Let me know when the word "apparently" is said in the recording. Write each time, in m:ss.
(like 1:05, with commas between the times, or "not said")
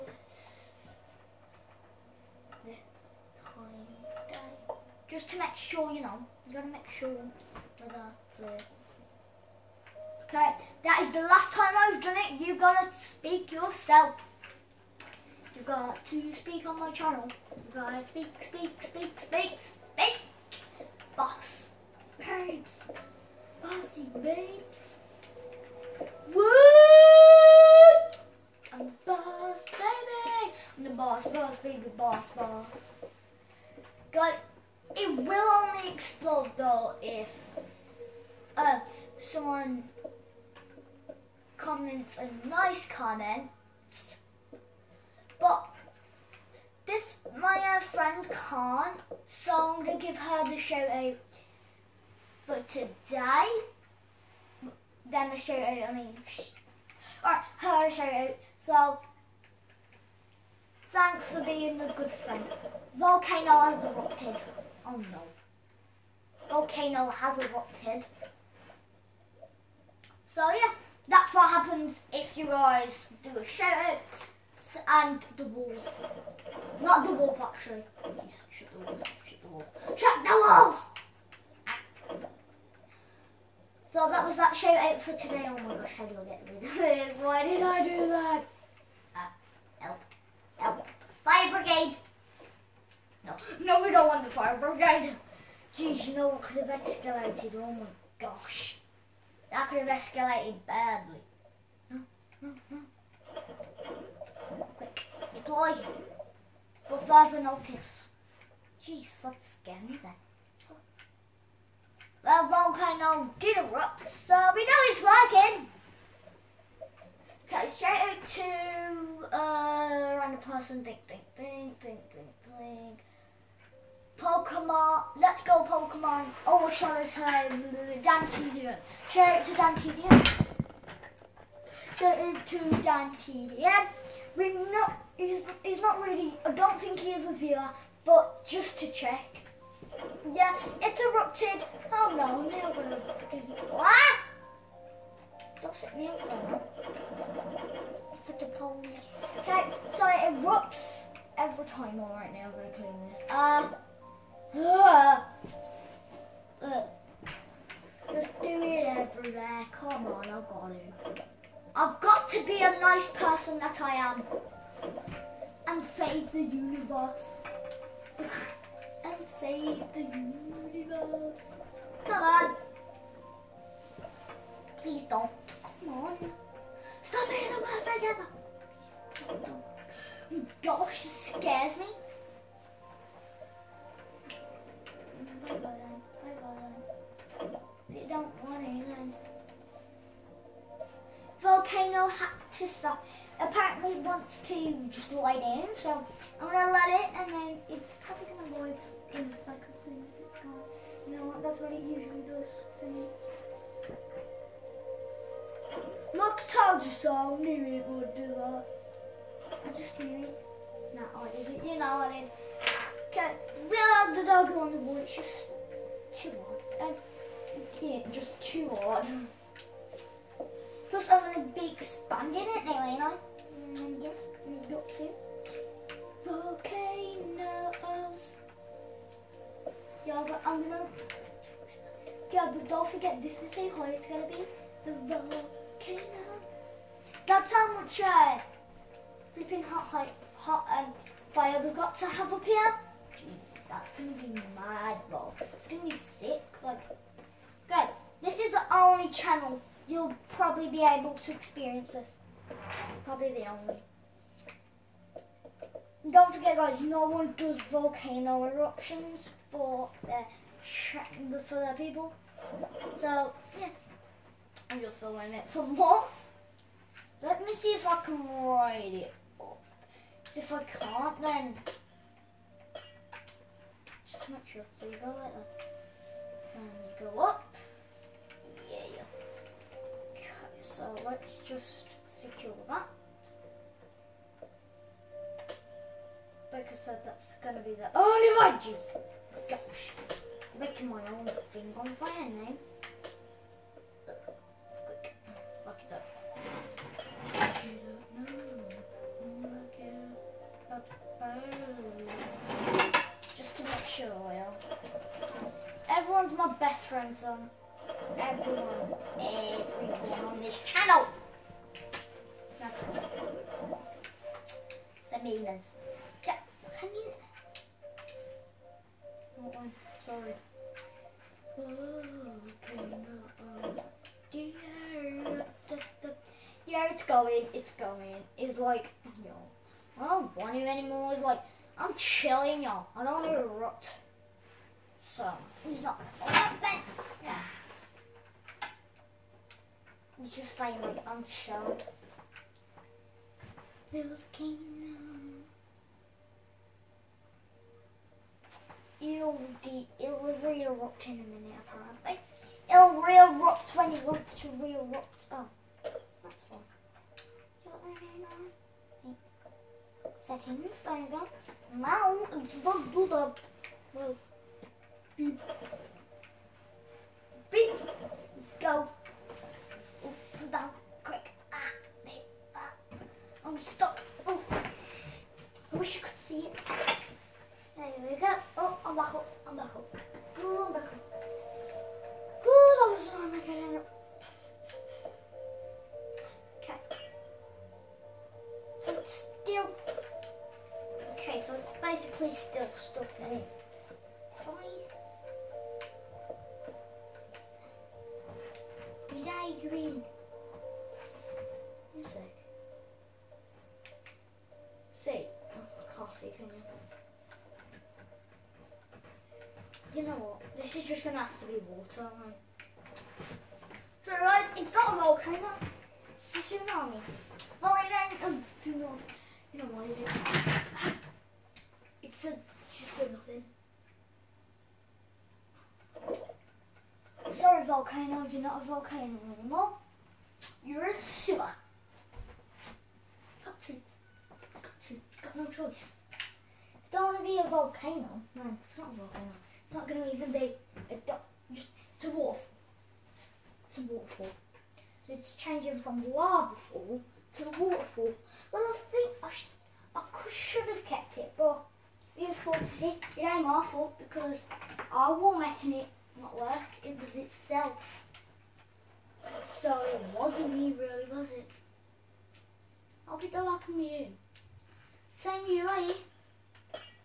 3:13, 5:51.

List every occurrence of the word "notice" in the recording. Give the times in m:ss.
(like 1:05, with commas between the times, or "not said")
1:47.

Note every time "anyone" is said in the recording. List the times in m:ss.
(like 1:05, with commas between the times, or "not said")
3:08.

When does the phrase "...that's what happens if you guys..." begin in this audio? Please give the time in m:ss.
1:11.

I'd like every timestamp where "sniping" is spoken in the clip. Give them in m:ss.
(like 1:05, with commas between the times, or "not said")
not said.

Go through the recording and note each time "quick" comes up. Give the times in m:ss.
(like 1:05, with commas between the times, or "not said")
1:44, 6:11.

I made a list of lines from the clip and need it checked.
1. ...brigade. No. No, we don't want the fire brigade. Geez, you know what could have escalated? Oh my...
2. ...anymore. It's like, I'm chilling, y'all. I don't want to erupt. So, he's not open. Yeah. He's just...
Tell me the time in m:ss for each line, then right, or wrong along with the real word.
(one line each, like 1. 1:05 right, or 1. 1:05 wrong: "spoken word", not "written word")
1. 1:31 right
2. 5:30 right.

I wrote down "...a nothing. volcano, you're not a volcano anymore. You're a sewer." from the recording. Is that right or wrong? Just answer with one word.
right.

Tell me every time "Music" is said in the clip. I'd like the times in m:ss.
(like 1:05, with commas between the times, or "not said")
6:41.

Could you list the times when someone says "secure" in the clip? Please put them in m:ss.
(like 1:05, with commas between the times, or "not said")
4:42.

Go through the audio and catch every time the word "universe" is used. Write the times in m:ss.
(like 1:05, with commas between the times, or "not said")
2:46, 2:50.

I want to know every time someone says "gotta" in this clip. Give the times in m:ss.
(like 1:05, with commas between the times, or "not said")
0:06, 0:12, 0:17.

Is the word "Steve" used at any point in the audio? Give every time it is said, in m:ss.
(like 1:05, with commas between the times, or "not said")
not said.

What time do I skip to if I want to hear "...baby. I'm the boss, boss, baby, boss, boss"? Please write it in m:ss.
0:29.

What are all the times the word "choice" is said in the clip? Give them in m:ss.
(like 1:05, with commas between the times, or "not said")
7:15.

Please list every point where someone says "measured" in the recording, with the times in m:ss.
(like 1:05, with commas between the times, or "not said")
not said.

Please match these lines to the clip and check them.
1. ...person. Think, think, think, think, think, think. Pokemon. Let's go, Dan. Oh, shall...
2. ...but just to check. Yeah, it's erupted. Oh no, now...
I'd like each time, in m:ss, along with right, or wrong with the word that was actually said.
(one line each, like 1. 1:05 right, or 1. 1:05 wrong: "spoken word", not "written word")
1. 2:00 wrong: "Pokemon", not "Dan"
2. 2:18 right.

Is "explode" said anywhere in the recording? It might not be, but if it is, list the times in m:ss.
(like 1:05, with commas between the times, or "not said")
0:35.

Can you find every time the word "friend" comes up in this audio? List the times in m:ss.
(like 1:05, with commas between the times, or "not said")
0:47, 1:02.